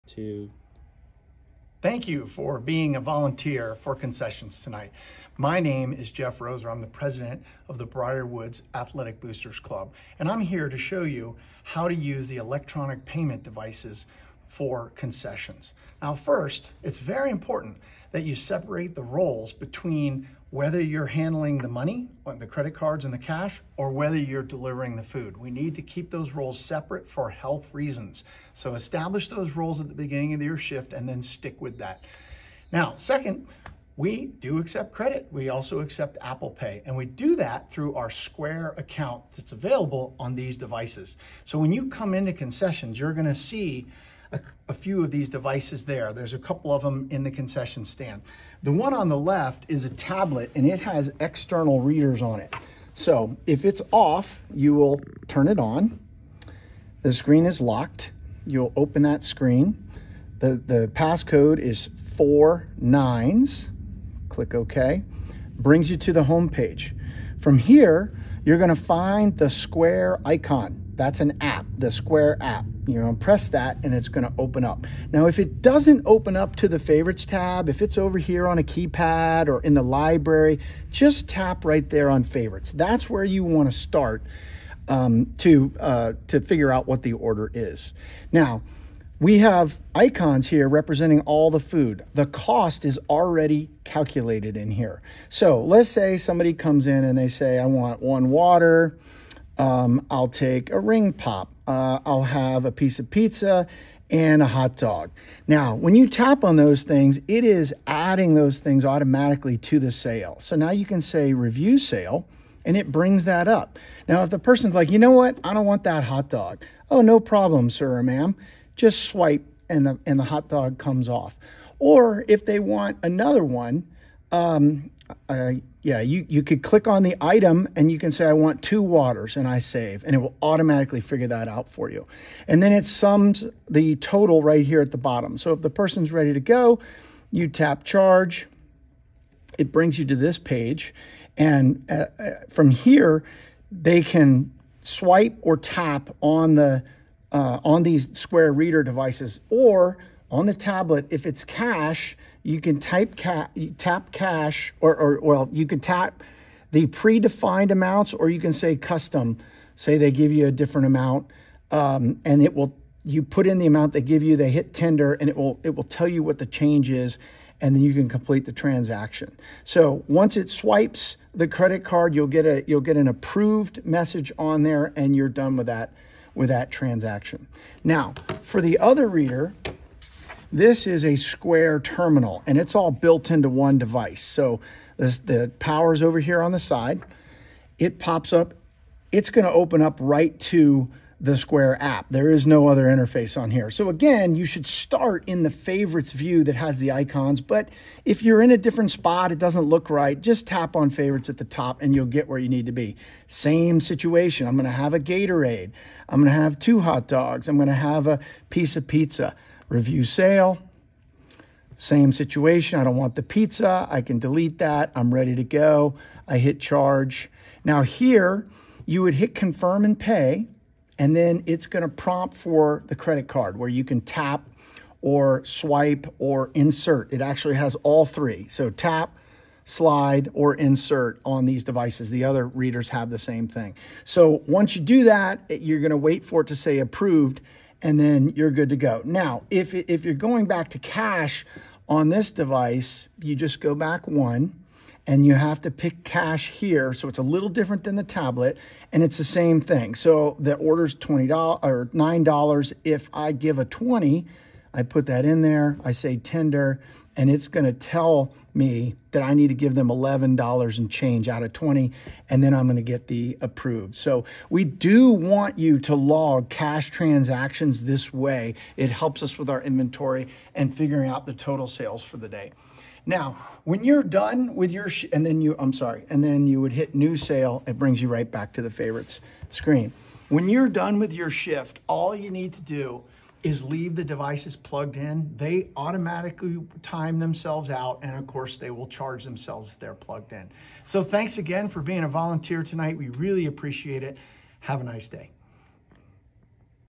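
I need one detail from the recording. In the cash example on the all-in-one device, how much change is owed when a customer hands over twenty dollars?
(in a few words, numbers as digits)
$11.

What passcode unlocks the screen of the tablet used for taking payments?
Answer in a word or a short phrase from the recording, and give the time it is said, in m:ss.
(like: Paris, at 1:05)
9999, at 1:02.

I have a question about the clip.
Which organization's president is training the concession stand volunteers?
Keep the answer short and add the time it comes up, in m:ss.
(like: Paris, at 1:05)
Briar Woods Athletic Boosters Club, at 0:07.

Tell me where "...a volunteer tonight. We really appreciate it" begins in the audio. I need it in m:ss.
4:52.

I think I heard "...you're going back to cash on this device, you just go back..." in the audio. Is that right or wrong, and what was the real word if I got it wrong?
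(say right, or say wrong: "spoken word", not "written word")
right.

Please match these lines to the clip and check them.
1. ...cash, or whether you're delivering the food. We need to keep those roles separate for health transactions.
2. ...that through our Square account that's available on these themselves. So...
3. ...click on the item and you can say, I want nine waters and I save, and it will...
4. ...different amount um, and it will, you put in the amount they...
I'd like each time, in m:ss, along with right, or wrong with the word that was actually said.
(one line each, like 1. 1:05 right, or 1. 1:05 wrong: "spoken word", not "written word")
1. 0:23 wrong: "reasons", not "transactions"
2. 0:37 wrong: "devices", not "themselves"
3. 2:06 wrong: "two", not "nine"
4. 2:40 right.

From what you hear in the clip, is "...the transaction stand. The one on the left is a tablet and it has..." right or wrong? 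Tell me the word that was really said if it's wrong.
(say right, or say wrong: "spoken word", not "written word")
wrong: "concession", not "transaction".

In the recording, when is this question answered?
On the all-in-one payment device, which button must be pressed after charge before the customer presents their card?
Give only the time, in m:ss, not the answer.
3:39.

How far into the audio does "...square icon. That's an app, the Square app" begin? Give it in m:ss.
1:09.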